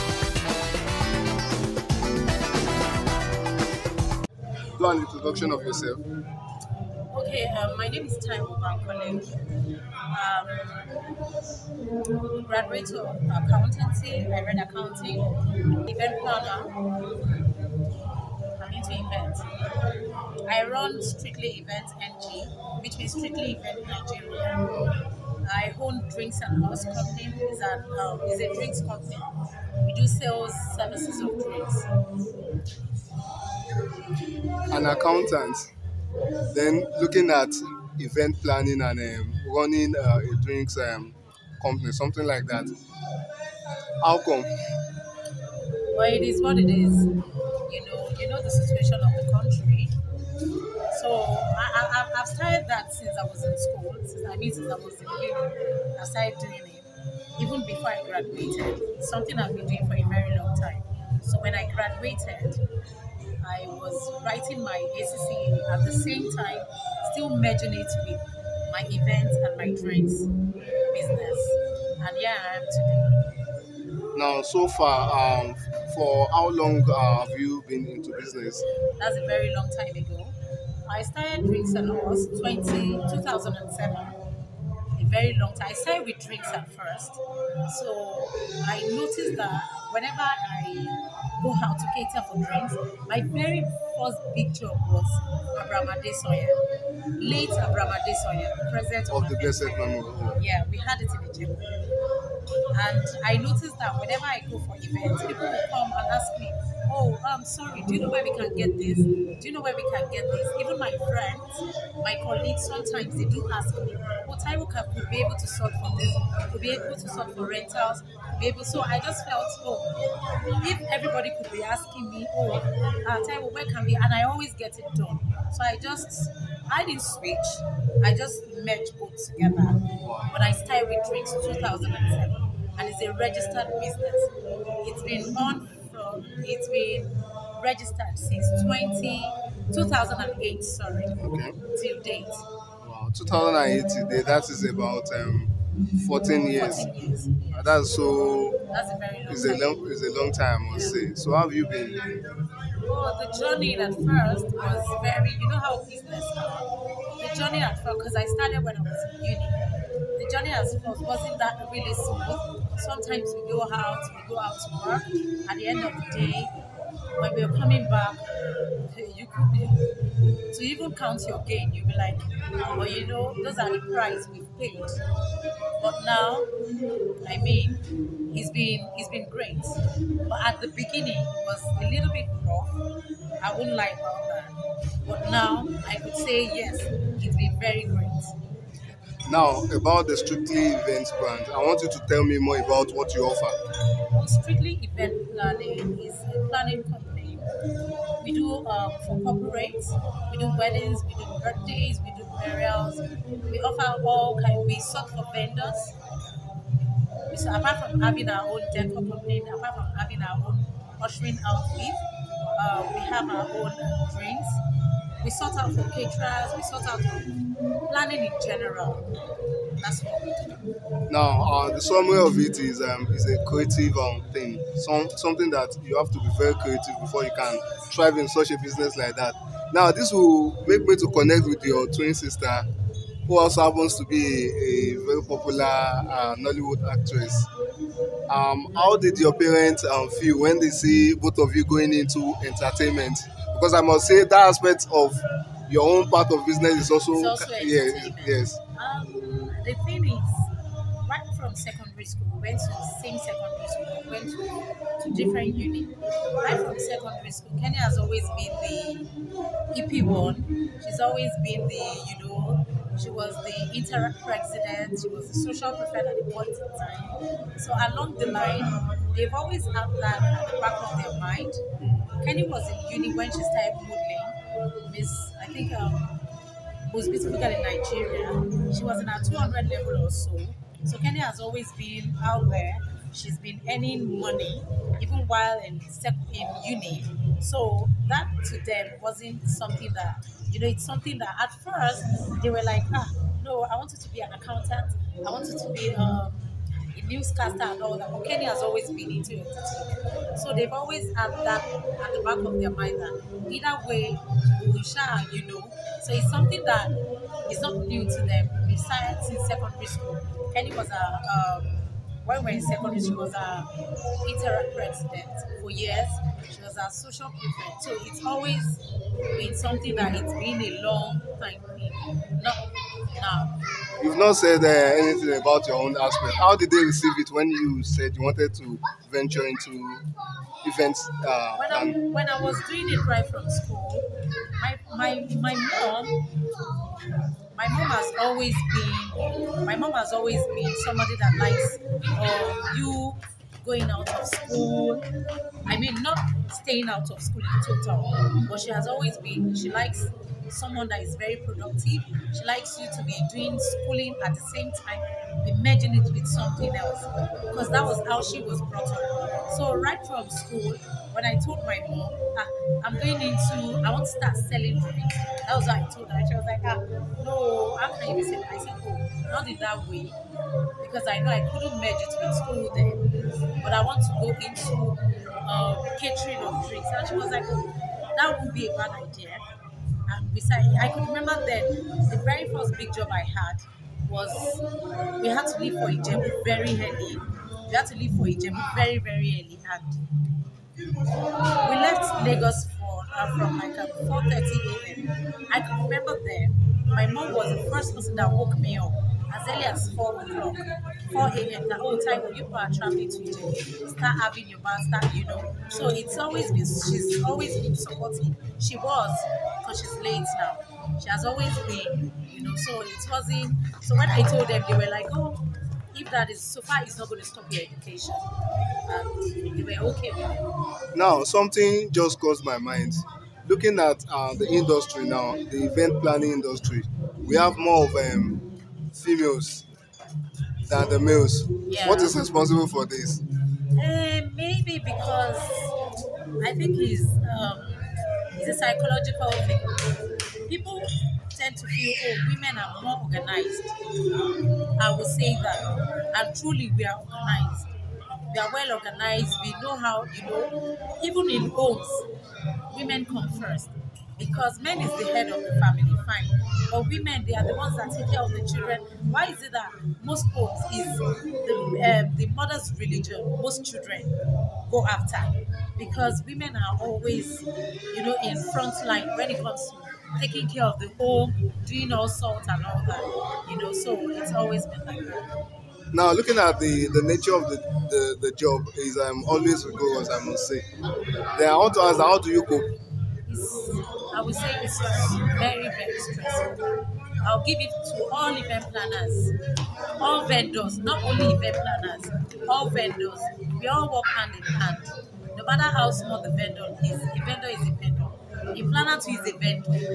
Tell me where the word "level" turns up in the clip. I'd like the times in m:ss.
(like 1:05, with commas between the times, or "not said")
4:39.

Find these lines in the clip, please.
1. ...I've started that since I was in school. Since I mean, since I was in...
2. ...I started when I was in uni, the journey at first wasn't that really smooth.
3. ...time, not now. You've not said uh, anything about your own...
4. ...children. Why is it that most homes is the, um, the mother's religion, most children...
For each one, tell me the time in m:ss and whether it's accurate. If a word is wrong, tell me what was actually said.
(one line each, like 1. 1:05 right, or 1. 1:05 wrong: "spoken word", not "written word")
1. 0:52 right
2. 2:38 right
3. 5:21 right
4. 7:38 right.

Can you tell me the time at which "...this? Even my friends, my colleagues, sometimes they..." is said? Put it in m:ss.
1:50.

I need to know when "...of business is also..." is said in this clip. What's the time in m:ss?
4:06.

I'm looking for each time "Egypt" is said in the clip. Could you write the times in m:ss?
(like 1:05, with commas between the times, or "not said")
1:41, 6:43.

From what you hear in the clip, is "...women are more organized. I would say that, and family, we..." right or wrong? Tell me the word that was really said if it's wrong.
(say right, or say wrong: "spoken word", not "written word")
wrong: "truly", not "family".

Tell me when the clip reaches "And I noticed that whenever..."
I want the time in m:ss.
1:42.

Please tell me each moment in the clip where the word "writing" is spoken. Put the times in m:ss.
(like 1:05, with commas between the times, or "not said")
1:04.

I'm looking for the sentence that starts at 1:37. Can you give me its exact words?
Late Abraham Soya, the president of, of the Blessed Memory.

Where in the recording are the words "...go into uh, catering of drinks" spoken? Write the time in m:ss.
6:14.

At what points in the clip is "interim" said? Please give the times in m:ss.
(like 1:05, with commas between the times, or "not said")
4:23, 5:14.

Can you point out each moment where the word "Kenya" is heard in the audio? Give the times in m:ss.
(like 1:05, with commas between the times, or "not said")
4:17, 4:58.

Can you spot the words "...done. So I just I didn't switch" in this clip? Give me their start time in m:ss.
2:04.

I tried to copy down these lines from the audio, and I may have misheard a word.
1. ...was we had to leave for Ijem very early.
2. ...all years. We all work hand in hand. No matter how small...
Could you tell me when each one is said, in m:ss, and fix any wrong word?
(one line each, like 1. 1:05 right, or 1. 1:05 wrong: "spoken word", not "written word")
1. 6:24 right
2. 8:12 wrong: "vendors", not "years".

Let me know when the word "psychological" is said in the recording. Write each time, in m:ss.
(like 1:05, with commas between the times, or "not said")
7:18.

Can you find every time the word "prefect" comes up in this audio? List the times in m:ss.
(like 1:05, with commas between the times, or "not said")
4:25, 5:17.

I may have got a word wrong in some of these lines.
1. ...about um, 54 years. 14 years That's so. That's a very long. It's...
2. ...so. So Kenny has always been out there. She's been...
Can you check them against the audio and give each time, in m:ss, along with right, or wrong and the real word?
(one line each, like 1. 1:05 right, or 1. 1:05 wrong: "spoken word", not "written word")
1. 2:24 wrong: "14", not "54"
2. 4:40 right.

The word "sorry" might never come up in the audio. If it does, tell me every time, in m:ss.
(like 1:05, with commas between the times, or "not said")
1:47, 2:20.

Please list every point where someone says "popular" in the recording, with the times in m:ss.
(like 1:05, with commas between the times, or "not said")
3:55.